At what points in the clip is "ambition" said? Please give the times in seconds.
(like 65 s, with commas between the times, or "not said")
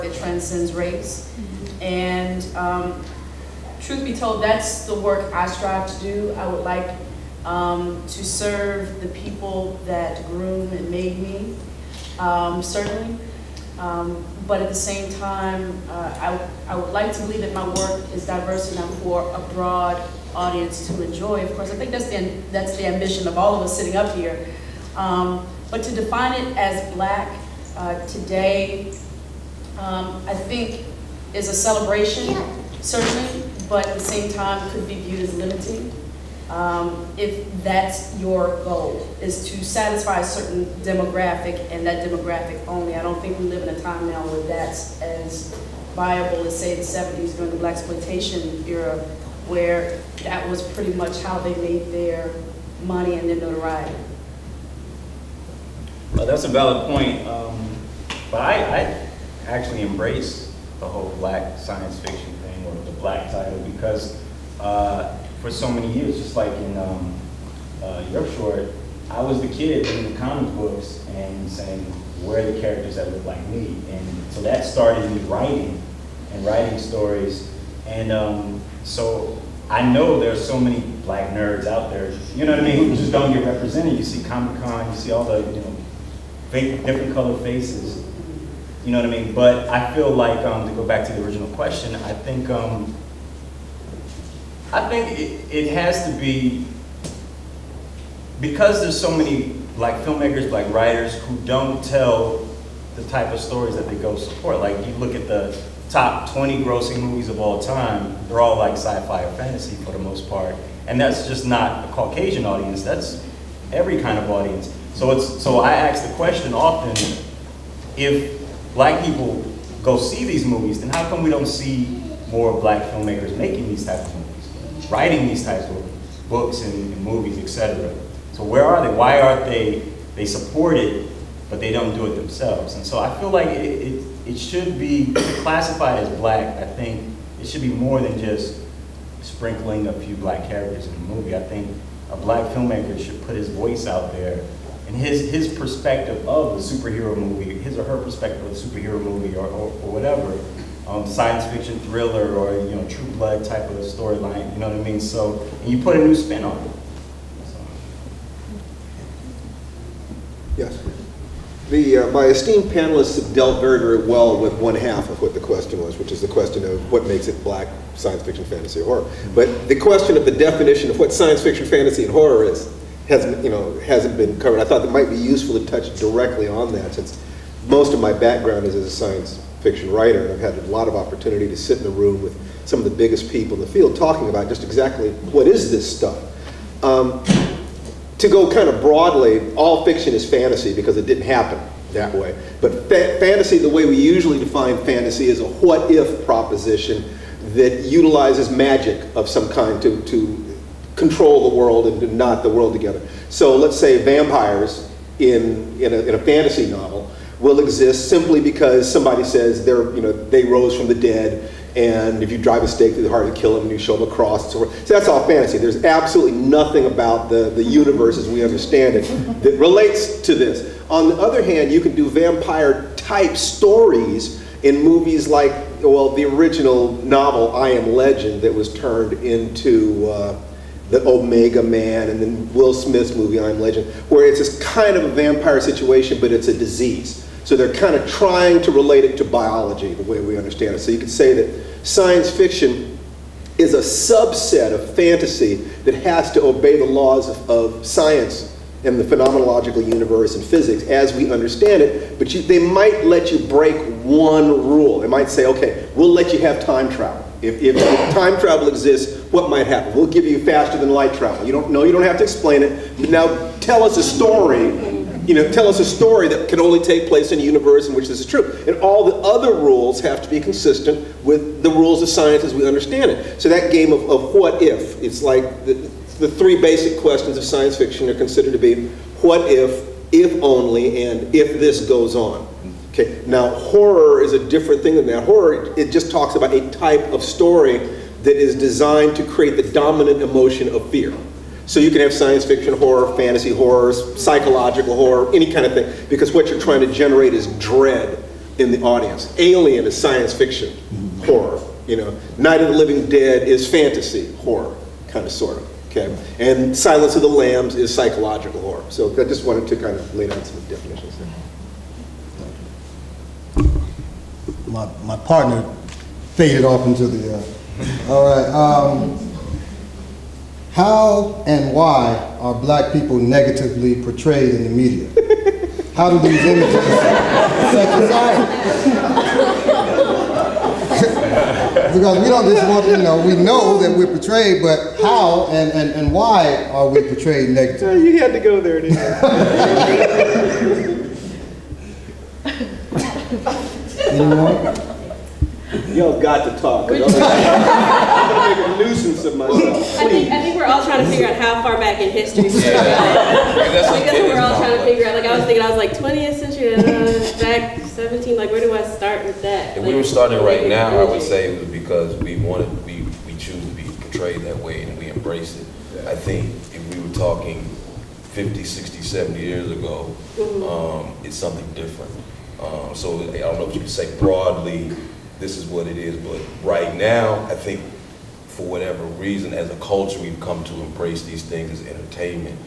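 22 s.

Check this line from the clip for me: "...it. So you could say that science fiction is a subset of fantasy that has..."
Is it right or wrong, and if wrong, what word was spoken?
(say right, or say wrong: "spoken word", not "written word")
right.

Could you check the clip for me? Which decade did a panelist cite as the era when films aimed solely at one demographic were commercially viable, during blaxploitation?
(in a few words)
the 70s.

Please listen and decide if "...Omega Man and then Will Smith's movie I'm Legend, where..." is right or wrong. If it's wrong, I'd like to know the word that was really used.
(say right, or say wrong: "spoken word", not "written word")
right.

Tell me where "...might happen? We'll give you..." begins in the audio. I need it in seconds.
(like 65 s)
259 s.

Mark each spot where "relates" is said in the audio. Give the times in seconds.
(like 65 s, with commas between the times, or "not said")
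219 s, 238 s.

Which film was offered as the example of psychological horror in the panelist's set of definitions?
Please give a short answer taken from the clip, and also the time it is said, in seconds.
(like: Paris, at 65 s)
Silence of the Lambs, at 306 s.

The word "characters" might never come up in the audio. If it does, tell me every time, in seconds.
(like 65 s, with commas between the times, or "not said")
72 s, 140 s.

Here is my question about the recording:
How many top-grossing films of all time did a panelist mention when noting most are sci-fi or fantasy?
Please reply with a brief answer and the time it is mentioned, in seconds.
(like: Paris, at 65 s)
20, at 105 s.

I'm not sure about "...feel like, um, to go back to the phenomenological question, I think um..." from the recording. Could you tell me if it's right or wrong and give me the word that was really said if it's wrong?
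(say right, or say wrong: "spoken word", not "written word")
wrong: "original", not "phenomenological".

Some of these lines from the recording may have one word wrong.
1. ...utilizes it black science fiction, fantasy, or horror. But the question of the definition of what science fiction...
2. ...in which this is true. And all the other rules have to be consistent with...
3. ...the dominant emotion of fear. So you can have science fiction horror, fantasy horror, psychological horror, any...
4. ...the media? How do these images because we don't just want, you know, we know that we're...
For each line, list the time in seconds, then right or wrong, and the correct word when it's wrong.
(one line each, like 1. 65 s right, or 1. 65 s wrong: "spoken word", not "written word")
1. 167 s wrong: "makes", not "utilizes"
2. 267 s right
3. 289 s right
4. 324 s right.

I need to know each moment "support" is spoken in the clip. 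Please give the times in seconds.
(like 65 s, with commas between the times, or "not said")
104 s, 130 s.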